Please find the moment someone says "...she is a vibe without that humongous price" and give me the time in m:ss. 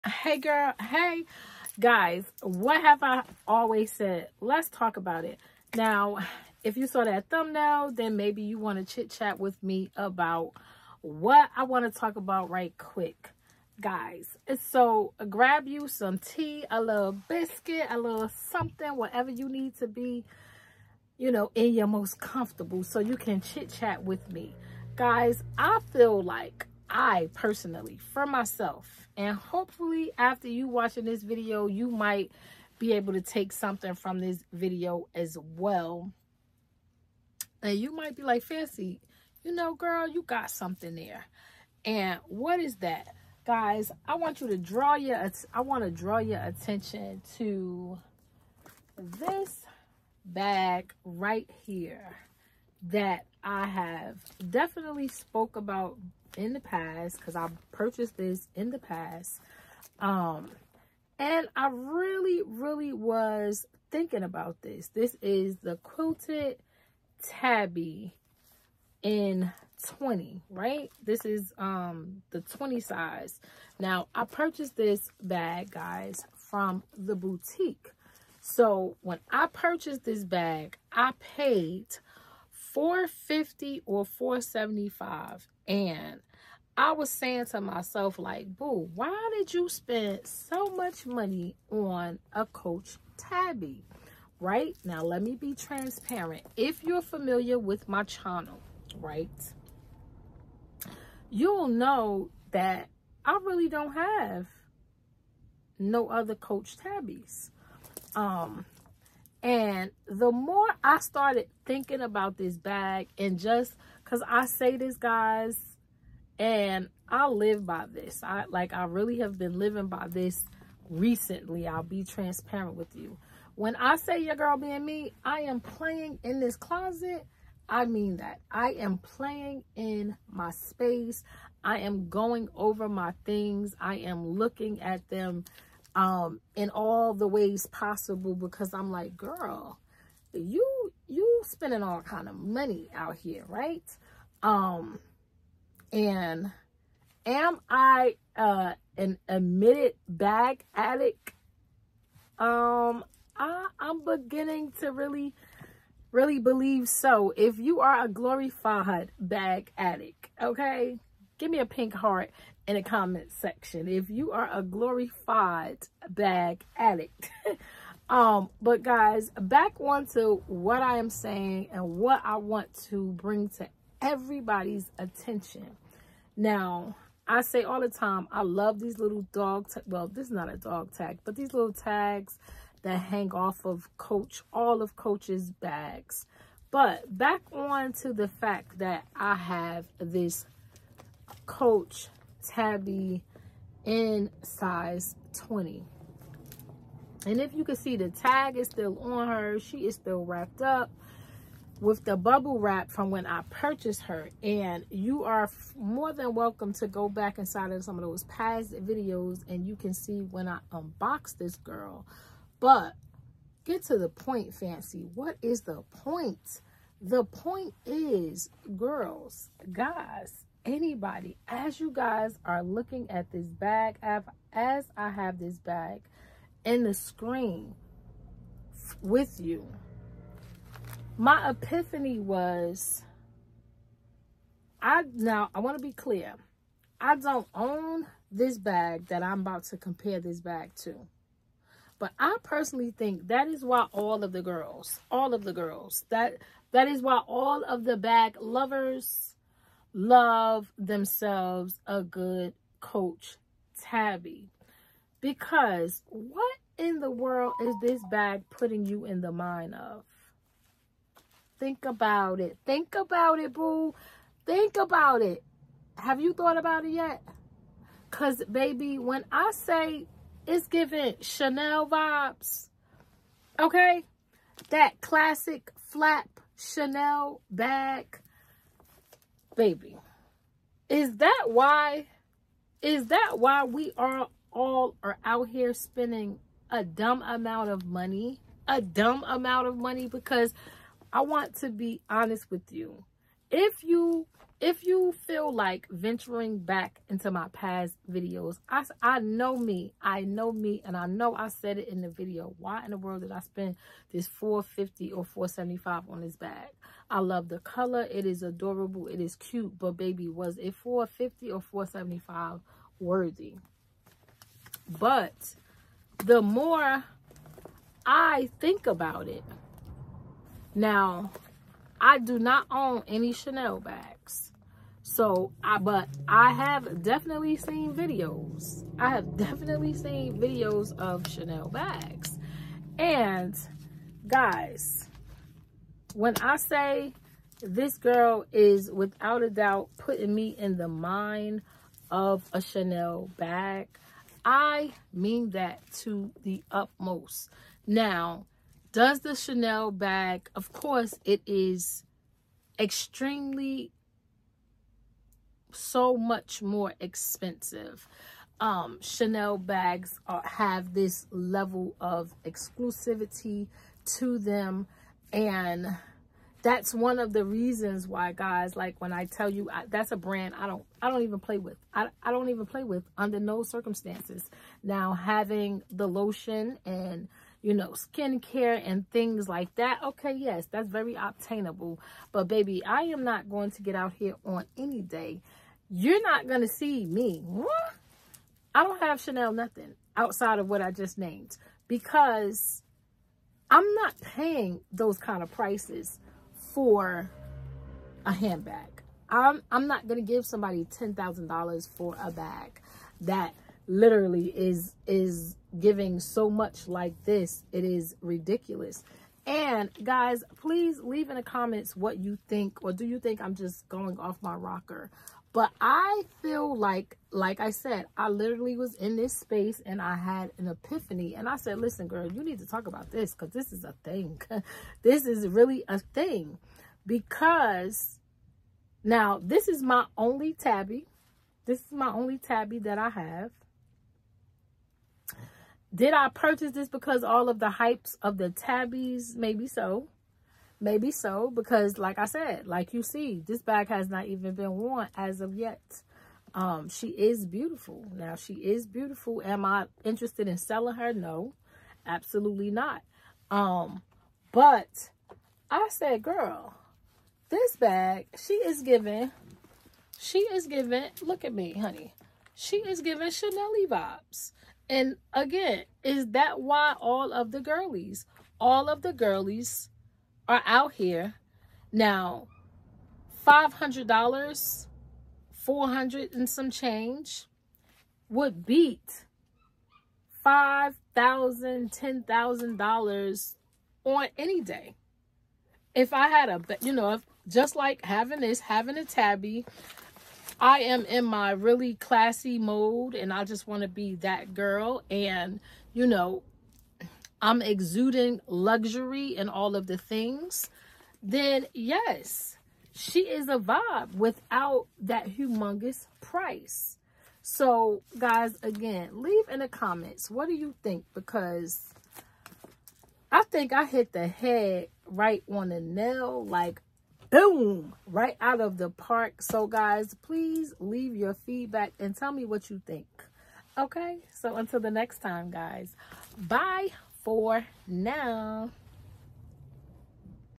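8:22.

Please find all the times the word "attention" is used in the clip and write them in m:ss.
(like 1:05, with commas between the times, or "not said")
0:46, 2:54.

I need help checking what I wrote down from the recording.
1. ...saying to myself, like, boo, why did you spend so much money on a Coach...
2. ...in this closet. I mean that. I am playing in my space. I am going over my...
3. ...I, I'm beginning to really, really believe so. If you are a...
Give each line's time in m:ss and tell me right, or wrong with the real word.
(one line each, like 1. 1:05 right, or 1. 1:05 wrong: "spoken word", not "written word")
1. 1:27 right
2. 2:06 right
3. 2:33 right.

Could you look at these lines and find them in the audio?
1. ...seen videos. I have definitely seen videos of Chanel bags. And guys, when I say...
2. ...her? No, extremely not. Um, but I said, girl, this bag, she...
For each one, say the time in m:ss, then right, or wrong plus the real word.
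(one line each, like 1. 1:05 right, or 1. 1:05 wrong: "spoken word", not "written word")
1. 5:27 right
2. 7:30 wrong: "absolutely", not "extremely".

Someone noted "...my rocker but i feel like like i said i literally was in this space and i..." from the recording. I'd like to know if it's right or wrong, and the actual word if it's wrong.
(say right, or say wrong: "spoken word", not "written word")
right.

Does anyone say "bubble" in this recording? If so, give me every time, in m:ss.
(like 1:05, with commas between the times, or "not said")
3:22.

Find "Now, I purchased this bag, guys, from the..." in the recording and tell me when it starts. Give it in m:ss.
1:13.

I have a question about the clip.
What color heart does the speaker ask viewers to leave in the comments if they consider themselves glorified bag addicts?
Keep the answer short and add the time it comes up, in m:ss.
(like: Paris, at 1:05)
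Pink, at 2:41.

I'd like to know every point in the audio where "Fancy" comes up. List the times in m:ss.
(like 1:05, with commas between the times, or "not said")
0:38, 3:34.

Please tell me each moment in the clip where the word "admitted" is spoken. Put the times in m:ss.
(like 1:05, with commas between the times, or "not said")
2:29.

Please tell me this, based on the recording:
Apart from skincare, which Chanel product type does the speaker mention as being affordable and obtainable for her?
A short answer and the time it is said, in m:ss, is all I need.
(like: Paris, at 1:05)
Lotion, at 6:16.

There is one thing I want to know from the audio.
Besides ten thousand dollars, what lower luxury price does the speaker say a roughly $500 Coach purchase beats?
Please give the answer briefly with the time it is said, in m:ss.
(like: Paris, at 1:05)
$5,000, at 8:00.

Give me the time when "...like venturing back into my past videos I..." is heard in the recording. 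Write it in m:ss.
4:55.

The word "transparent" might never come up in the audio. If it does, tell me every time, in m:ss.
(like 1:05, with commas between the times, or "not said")
1:35, 2:02.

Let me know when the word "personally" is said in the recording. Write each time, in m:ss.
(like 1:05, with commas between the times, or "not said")
0:27, 4:02.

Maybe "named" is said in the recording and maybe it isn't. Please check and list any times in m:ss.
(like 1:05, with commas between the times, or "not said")
6:31.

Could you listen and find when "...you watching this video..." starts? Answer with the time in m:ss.
0:30.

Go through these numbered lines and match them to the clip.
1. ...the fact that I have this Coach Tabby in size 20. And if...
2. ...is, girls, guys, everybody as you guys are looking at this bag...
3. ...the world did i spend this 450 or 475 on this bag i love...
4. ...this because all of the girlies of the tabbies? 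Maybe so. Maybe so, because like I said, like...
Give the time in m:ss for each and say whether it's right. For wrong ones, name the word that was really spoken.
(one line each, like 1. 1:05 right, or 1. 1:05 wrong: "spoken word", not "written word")
1. 3:08 right
2. 3:37 wrong: "anybody", not "everybody"
3. 5:02 right
4. 7:16 wrong: "hypes", not "girlies".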